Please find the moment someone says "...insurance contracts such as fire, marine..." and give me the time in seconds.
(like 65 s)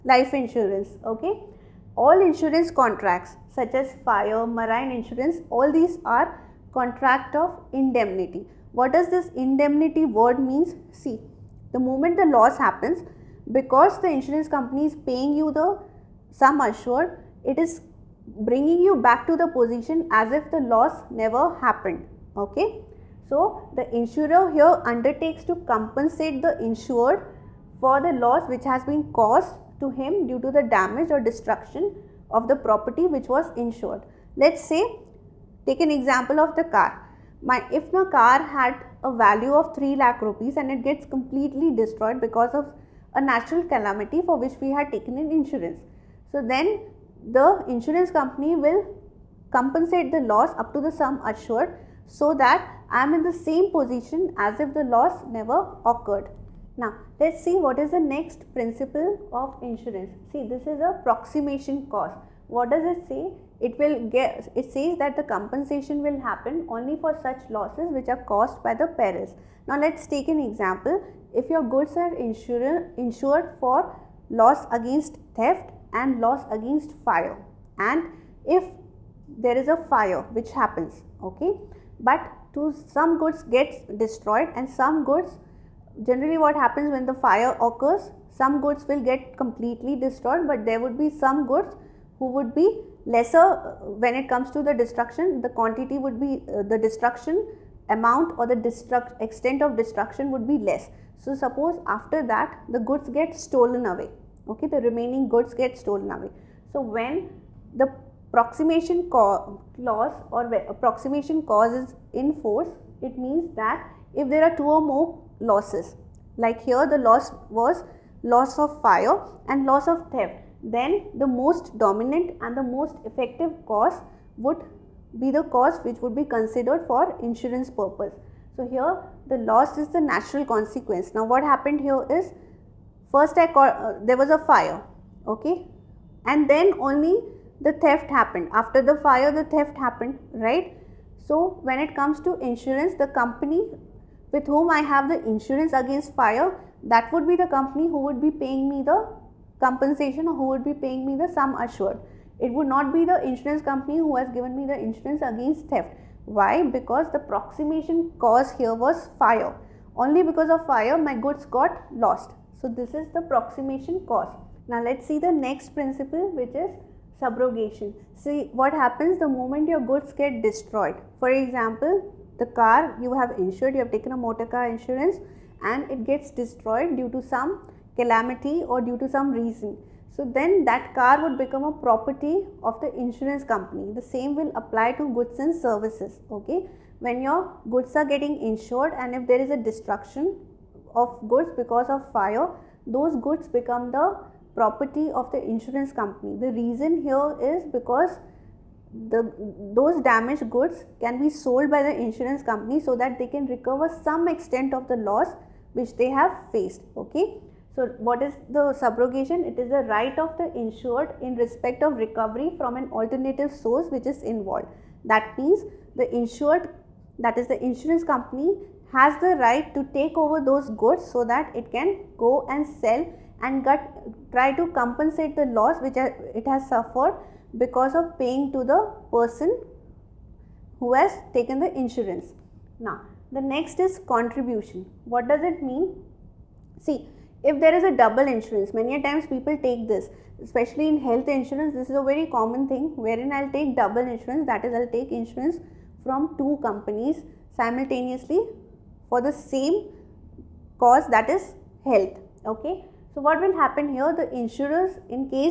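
2 s.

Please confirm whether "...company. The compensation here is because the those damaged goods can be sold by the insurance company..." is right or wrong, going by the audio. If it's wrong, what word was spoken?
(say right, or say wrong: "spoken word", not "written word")
wrong: "reason", not "compensation".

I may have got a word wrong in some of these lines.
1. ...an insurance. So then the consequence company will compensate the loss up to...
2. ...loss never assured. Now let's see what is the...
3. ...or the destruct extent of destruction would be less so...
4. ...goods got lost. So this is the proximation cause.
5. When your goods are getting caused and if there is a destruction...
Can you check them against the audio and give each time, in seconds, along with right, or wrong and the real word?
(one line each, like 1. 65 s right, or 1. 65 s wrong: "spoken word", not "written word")
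1. 45 s wrong: "insurance", not "consequence"
2. 54 s wrong: "occurred", not "assured"
3. 98 s right
4. 161 s right
5. 186 s wrong: "insured", not "caused".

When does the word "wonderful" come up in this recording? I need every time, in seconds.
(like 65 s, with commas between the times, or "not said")
not said.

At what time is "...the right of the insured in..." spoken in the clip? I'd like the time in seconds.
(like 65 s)
209 s.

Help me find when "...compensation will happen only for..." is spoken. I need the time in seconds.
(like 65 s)
65 s.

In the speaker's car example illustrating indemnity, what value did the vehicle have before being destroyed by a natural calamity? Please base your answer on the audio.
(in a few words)
3 lakh rupees.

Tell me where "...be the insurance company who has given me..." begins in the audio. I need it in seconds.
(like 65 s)
152 s.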